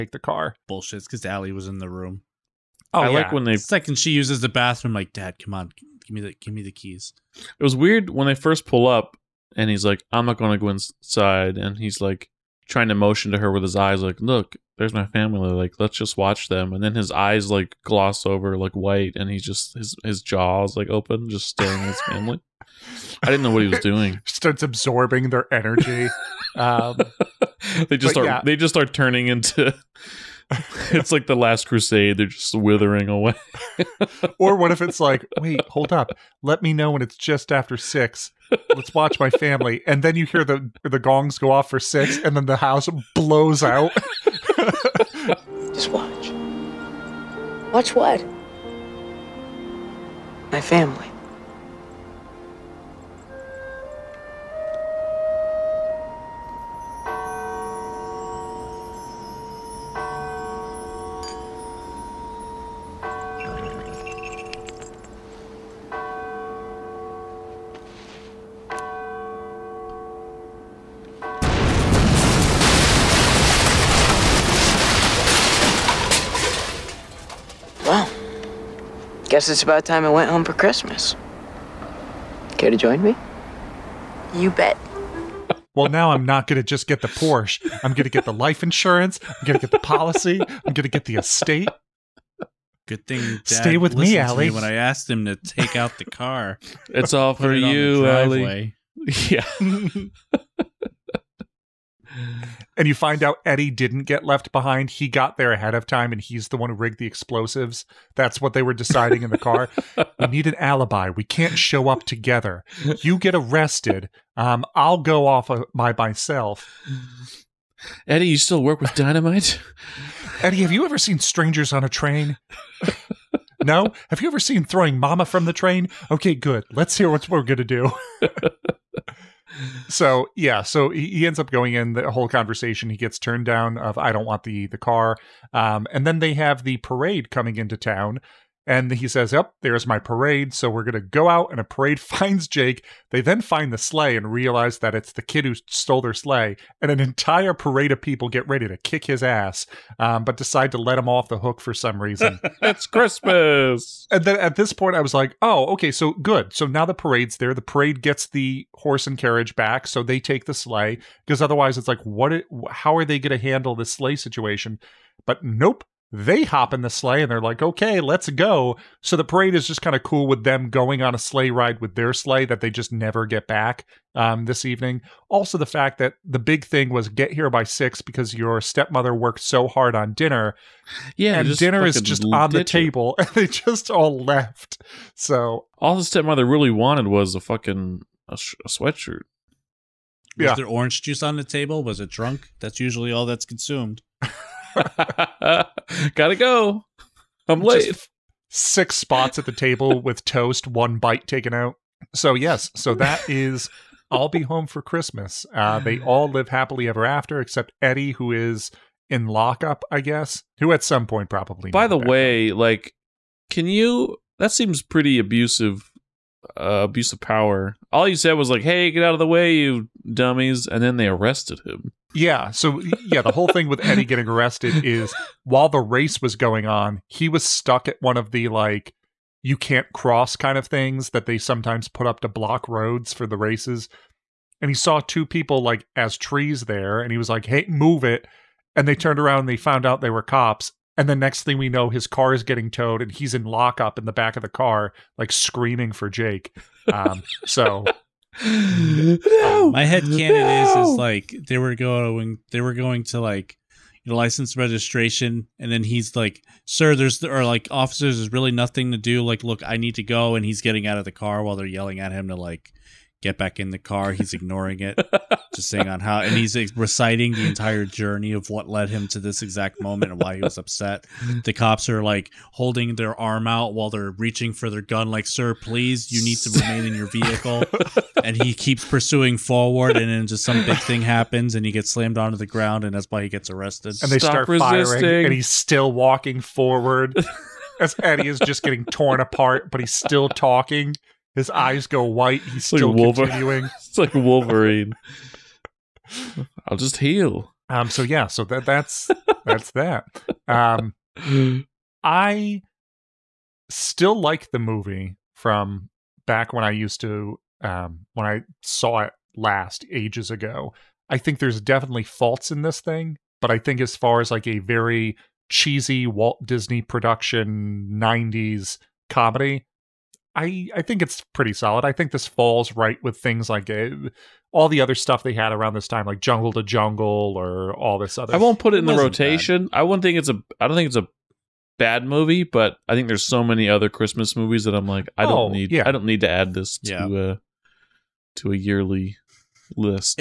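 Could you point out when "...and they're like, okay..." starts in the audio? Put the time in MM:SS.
02:47.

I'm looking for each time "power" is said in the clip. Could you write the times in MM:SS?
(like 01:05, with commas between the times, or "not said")
03:37.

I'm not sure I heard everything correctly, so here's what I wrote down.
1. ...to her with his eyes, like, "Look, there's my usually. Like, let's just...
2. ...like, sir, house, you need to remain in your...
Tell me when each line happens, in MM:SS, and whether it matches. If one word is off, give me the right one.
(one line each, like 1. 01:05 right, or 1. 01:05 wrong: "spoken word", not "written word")
1. 00:13 wrong: "family", not "usually"
2. 04:35 wrong: "please", not "house".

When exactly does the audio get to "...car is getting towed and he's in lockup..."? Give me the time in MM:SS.
04:02.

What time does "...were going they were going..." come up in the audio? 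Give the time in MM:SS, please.
04:11.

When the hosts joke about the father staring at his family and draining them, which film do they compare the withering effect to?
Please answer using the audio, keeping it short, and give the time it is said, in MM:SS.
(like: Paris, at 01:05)
The Last Crusade, at 00:31.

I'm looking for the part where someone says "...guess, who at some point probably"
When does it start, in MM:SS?
03:30.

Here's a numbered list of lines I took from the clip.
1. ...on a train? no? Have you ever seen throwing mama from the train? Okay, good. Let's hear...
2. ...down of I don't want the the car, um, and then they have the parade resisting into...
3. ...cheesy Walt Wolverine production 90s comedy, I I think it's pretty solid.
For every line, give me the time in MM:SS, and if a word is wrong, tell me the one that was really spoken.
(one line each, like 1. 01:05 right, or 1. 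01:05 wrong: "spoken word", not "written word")
1. 02:01 right
2. 02:13 wrong: "coming", not "resisting"
3. 05:15 wrong: "Disney", not "Wolverine".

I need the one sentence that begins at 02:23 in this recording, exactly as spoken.
They then find the sleigh and realize that it's the kid who stole their sleigh.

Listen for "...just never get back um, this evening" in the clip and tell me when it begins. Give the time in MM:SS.
02:52.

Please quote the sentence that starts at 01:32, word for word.
Good thing Dad Stay with me, Allie.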